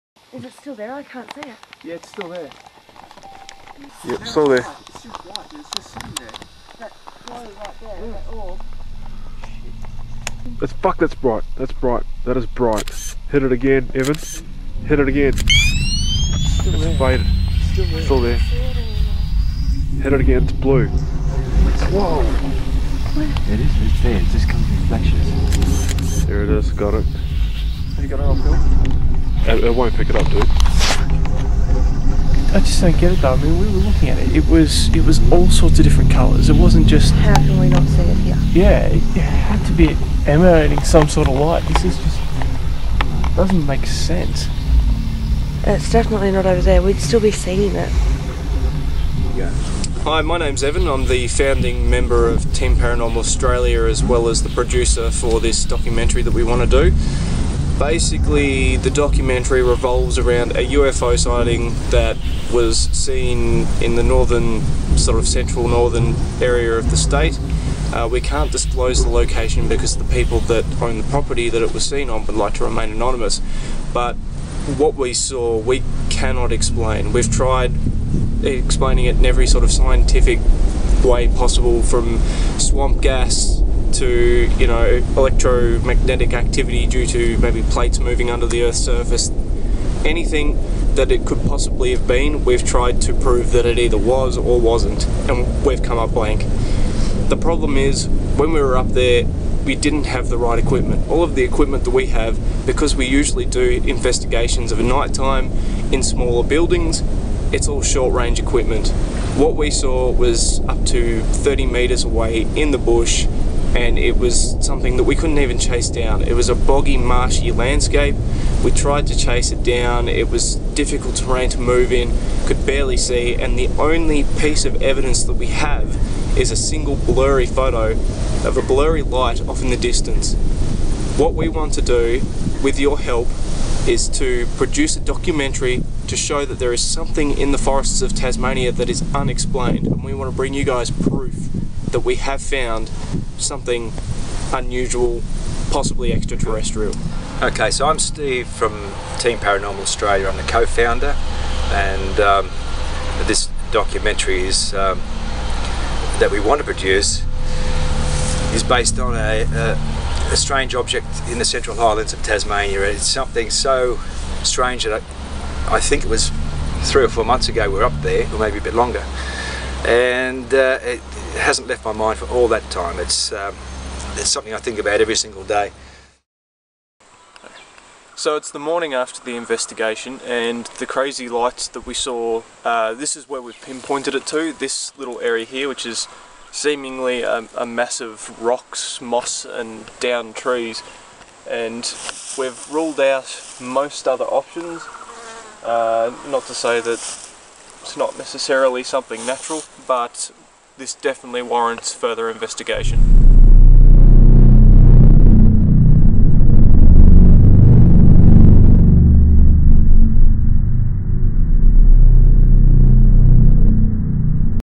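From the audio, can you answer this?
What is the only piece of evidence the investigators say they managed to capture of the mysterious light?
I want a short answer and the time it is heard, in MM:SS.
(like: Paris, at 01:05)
a single blurry photo, at 02:06.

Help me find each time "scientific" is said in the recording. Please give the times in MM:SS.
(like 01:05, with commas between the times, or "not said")
01:19.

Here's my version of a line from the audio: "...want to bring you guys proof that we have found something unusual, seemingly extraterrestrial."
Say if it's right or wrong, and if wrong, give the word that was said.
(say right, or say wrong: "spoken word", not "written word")
wrong: "possibly", not "seemingly".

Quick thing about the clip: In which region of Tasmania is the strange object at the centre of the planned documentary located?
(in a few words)
Central Highlands.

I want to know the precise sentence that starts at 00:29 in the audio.
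It, it won't pick it up, dude.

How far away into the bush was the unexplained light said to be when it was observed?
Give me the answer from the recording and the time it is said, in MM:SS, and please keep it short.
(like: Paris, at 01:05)
30 meters, at 01:51.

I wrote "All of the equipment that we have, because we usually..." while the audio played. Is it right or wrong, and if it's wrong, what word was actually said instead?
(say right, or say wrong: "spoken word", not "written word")
right.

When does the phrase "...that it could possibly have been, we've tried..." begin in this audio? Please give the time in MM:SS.
01:30.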